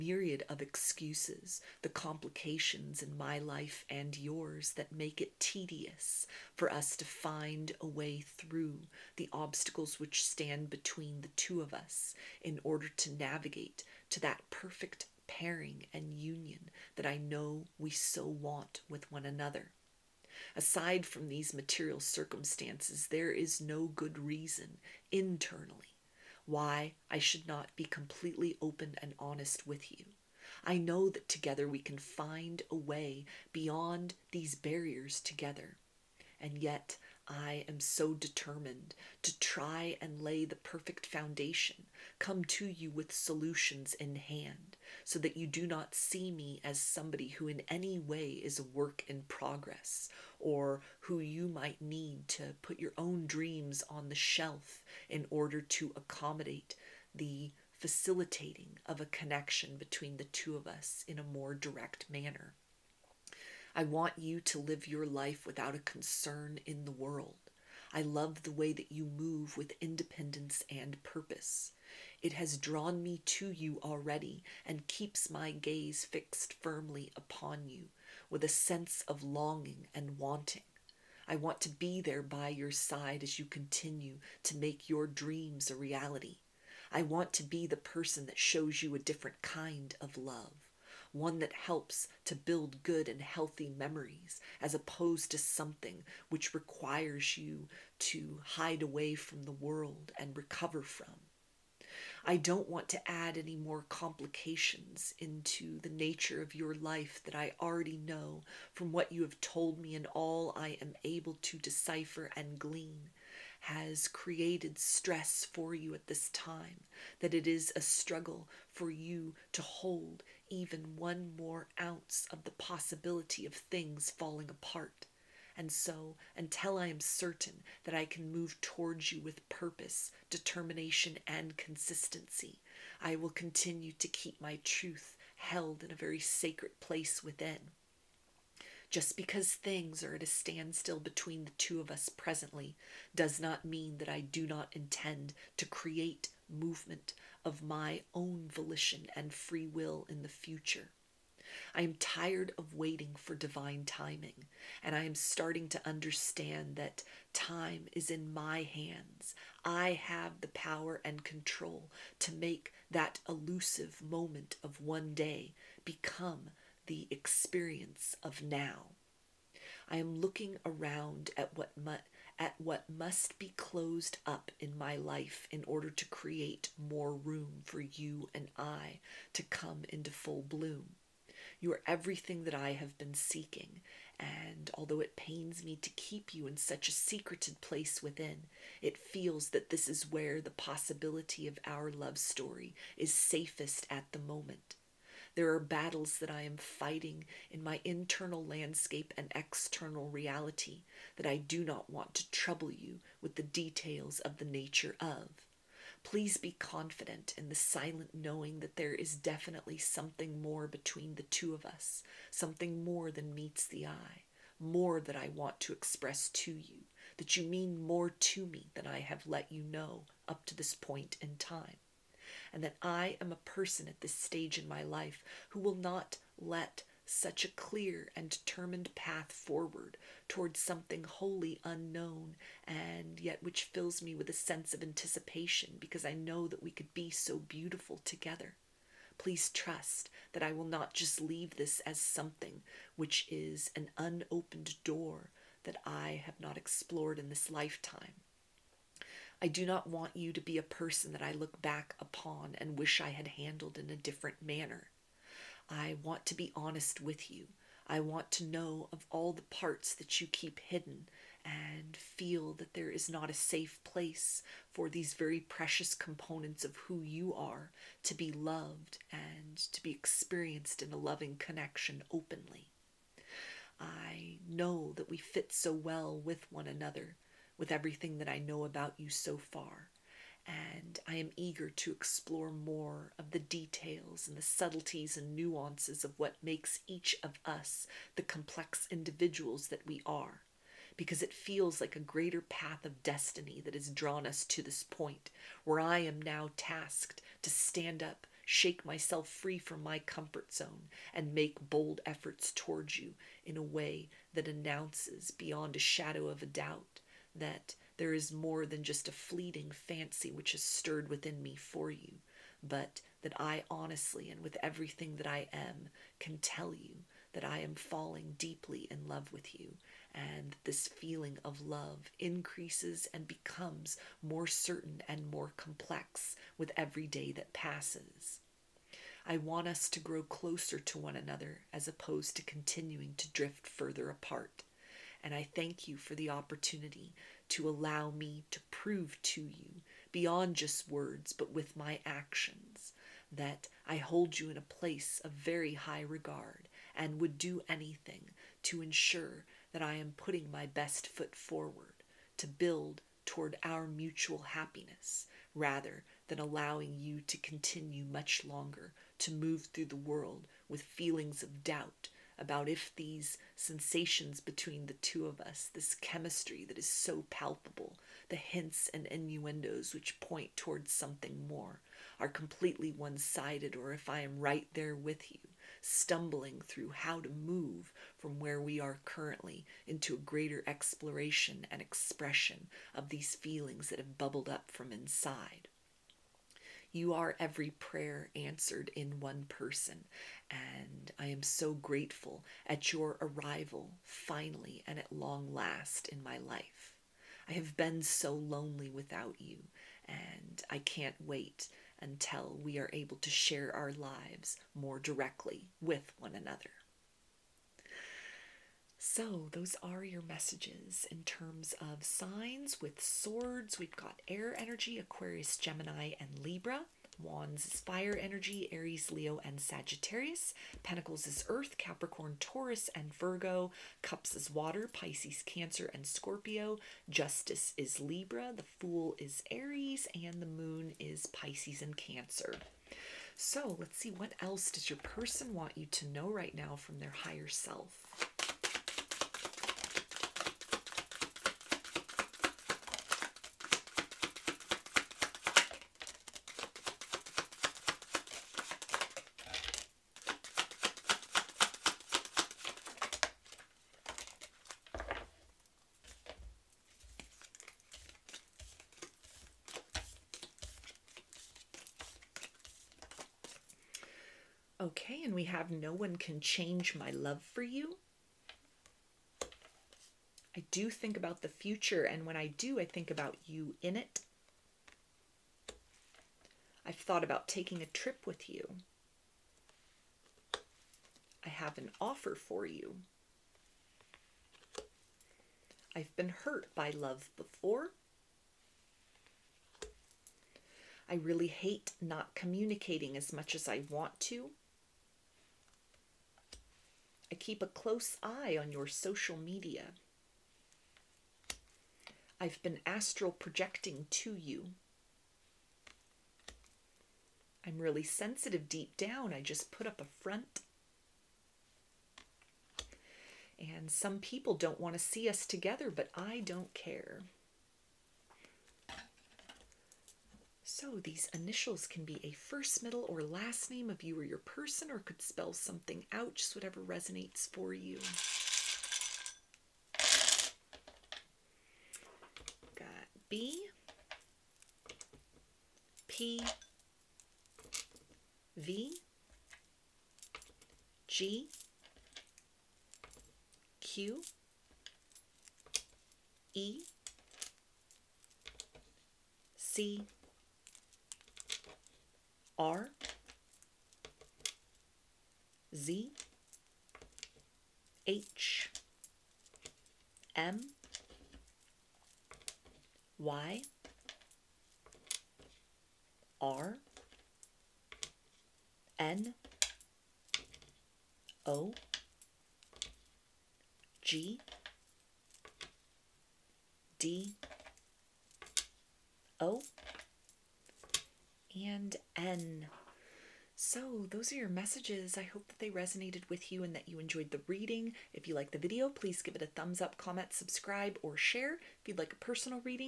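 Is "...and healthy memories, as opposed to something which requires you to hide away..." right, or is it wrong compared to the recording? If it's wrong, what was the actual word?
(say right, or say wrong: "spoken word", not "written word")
right.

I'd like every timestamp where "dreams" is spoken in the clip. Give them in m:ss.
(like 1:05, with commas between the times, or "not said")
0:53, 1:25.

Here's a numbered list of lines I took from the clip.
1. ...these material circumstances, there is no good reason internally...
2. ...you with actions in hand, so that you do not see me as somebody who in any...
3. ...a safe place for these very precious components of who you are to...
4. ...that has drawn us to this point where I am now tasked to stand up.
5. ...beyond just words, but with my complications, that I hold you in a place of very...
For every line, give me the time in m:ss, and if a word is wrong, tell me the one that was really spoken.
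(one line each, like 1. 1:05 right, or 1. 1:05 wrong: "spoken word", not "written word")
1. 0:21 right
2. 0:42 wrong: "solutions", not "actions"
3. 4:23 right
4. 4:53 right
5. 5:40 wrong: "actions", not "complications".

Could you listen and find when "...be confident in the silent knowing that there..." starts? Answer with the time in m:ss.
3:26.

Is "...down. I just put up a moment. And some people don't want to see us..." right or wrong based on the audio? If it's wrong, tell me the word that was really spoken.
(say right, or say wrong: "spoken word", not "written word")
wrong: "front", not "moment".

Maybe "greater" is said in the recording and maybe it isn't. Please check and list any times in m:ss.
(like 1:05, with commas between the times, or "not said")
4:52, 6:20.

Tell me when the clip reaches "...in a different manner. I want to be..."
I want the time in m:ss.
4:13.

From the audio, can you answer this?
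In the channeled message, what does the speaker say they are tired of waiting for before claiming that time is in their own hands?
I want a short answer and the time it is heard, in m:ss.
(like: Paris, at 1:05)
Divine timing, at 2:33.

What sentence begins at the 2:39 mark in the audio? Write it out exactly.
I have the power and control to make that elusive moment of one day become the experience of now.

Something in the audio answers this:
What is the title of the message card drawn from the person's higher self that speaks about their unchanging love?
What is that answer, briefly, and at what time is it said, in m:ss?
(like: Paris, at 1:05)
No One Can Change My Love for You, at 7:45.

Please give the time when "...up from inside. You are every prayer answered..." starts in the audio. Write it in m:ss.
6:24.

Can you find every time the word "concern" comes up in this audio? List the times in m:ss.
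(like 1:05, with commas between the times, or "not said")
1:05.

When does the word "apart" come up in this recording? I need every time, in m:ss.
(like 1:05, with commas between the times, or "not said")
2:04, 5:34.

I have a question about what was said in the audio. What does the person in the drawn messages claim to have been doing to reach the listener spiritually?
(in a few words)
Astral projecting.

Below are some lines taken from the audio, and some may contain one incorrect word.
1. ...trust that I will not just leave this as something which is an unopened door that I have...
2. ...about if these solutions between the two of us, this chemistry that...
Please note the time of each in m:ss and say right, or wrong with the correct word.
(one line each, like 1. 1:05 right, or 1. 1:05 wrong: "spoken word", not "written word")
1. 3:59 right
2. 6:02 wrong: "sensations", not "solutions".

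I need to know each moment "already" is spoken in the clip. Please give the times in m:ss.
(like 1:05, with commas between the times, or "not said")
1:13, 1:47.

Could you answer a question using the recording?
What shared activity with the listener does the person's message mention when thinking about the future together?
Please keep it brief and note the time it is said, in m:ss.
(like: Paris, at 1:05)
Taking a trip, at 7:57.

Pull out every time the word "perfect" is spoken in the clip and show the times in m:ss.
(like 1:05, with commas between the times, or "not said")
0:14, 0:40.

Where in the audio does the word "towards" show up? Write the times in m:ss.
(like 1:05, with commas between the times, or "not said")
2:08, 3:50, 5:02, 5:53, 6:10.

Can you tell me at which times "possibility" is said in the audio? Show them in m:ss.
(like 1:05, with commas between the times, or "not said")
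2:02, 3:10.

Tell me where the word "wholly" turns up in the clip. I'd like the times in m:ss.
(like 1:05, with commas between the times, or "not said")
3:51.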